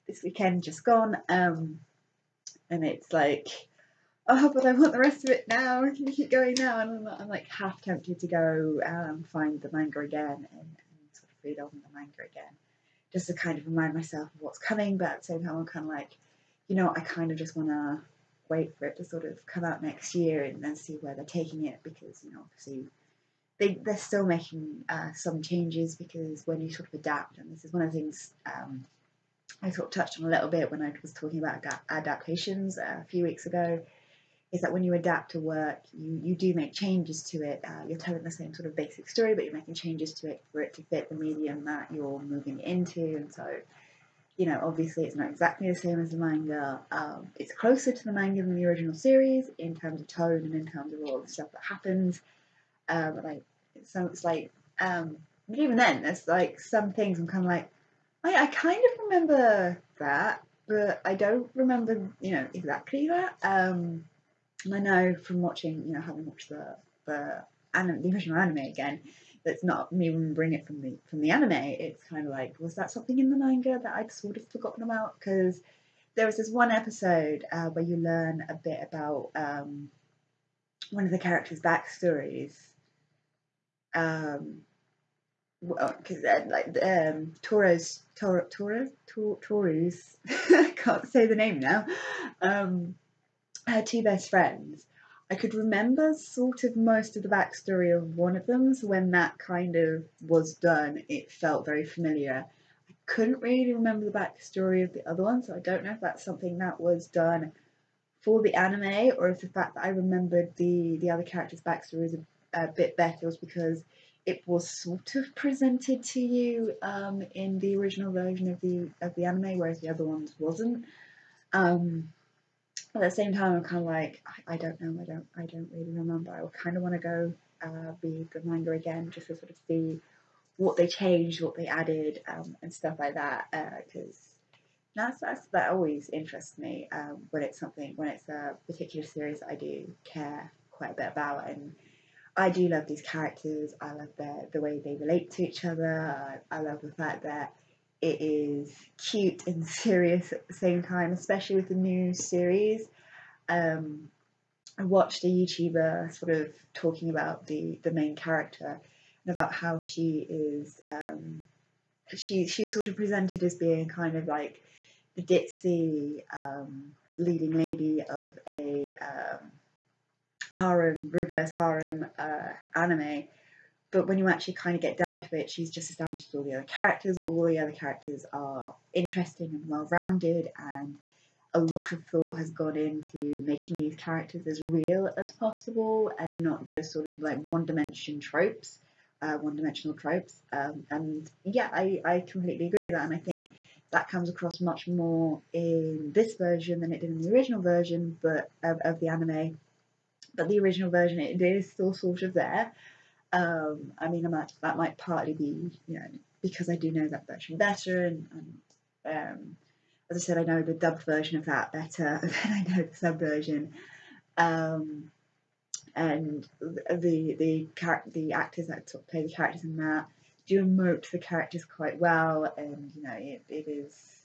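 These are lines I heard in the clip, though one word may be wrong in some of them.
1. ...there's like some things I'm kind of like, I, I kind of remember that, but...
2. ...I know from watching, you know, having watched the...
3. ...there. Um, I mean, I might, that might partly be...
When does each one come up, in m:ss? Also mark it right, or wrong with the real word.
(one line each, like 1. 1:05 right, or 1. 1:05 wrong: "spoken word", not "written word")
1. 0:56 right
2. 1:04 right
3. 3:22 right.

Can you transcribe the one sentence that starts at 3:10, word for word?
Um, and yeah, I, I completely agree with that.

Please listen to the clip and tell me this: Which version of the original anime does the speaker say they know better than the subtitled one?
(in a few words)
dubbed version.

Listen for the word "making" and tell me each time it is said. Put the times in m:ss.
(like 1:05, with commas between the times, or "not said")
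0:24, 0:39, 3:03.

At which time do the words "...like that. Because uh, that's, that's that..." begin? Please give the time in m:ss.
2:12.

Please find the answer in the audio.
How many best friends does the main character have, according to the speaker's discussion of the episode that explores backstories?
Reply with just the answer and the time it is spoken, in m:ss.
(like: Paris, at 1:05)
2, at 1:33.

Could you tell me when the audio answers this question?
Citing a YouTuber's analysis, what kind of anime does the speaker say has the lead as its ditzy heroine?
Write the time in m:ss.
2:51.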